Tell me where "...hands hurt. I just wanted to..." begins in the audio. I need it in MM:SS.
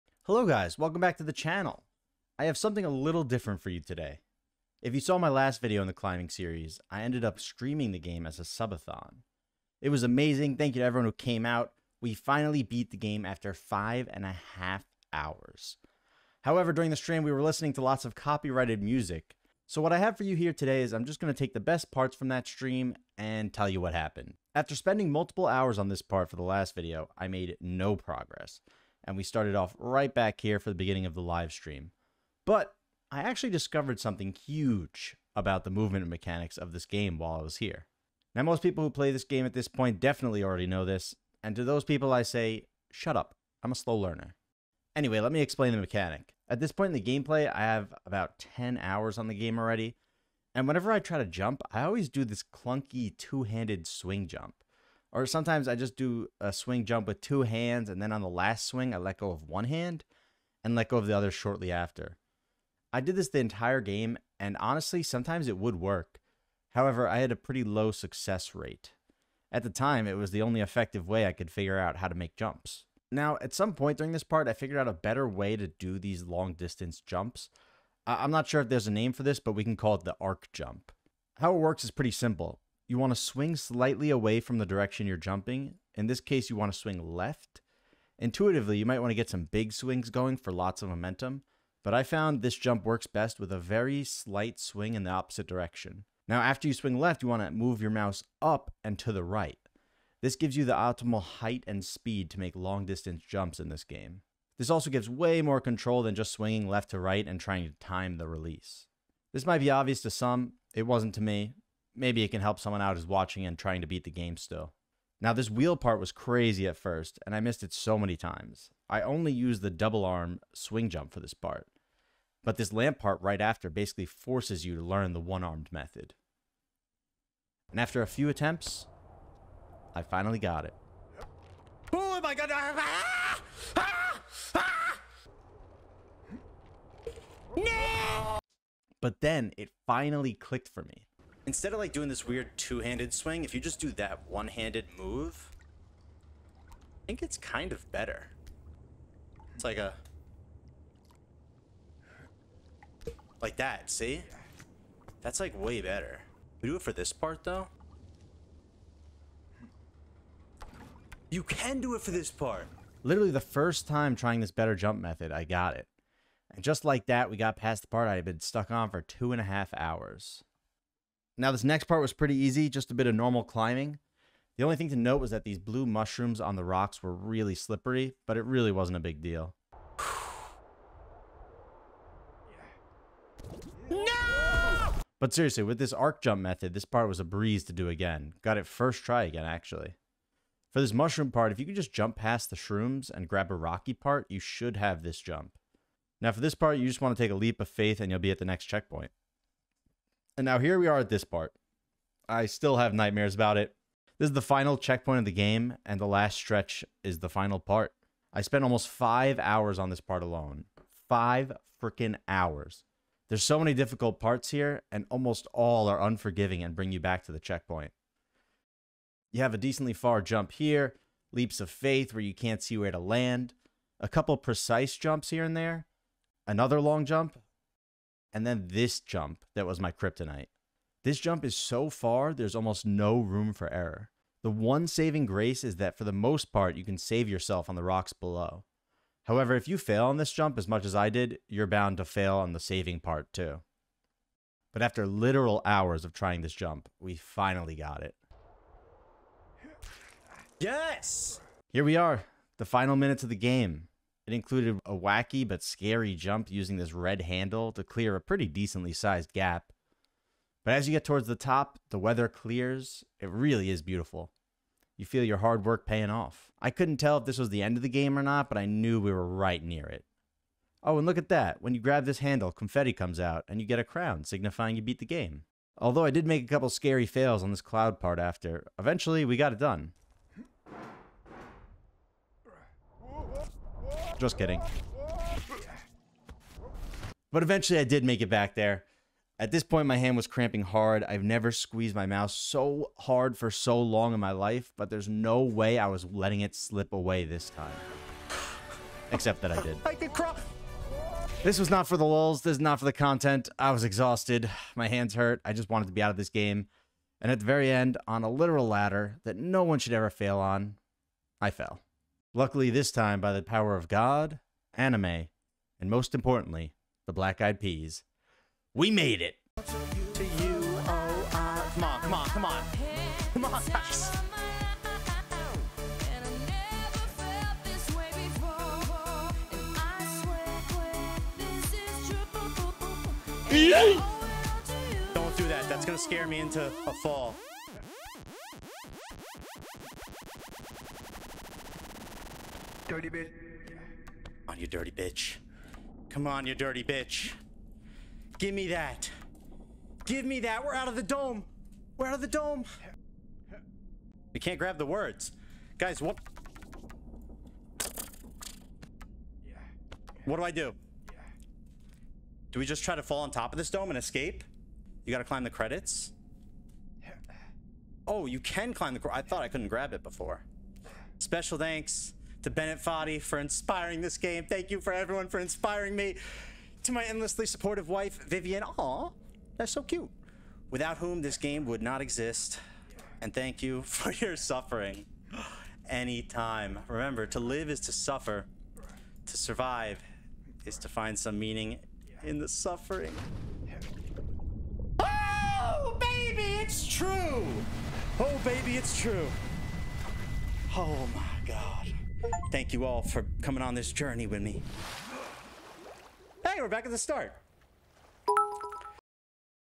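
05:04.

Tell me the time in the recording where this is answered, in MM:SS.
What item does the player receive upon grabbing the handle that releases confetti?
04:33.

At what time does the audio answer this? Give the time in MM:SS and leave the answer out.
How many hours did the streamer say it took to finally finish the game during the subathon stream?
00:13.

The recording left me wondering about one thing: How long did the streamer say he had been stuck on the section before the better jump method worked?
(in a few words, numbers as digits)
2 and a half hours.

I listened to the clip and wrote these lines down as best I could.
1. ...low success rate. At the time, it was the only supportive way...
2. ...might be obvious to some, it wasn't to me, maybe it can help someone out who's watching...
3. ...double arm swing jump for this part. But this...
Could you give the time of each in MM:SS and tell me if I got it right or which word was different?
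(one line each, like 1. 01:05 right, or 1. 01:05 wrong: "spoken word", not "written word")
1. 01:07 wrong: "effective", not "supportive"
2. 01:49 right
3. 01:59 right.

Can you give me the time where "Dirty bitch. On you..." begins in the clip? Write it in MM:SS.
05:42.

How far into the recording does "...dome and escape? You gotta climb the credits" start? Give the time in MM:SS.
06:03.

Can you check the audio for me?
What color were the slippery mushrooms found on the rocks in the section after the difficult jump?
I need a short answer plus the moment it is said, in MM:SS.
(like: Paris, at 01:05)
blue, at 02:55.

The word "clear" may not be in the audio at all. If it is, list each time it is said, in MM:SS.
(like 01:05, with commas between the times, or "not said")
04:17, 04:22.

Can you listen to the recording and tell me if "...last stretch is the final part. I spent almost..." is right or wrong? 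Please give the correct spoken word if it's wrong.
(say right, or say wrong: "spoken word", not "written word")
right.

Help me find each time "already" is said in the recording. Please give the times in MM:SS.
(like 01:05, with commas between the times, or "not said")
00:40, 00:49.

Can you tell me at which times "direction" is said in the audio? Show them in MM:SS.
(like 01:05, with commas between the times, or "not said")
01:24, 01:35.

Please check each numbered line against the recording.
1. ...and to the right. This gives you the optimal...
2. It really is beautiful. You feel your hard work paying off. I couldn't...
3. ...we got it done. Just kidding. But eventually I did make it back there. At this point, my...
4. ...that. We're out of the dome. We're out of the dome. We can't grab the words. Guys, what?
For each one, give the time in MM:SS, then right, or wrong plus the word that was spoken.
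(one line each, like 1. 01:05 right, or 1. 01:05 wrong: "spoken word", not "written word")
1. 01:38 right
2. 04:23 right
3. 04:39 right
4. 05:50 right.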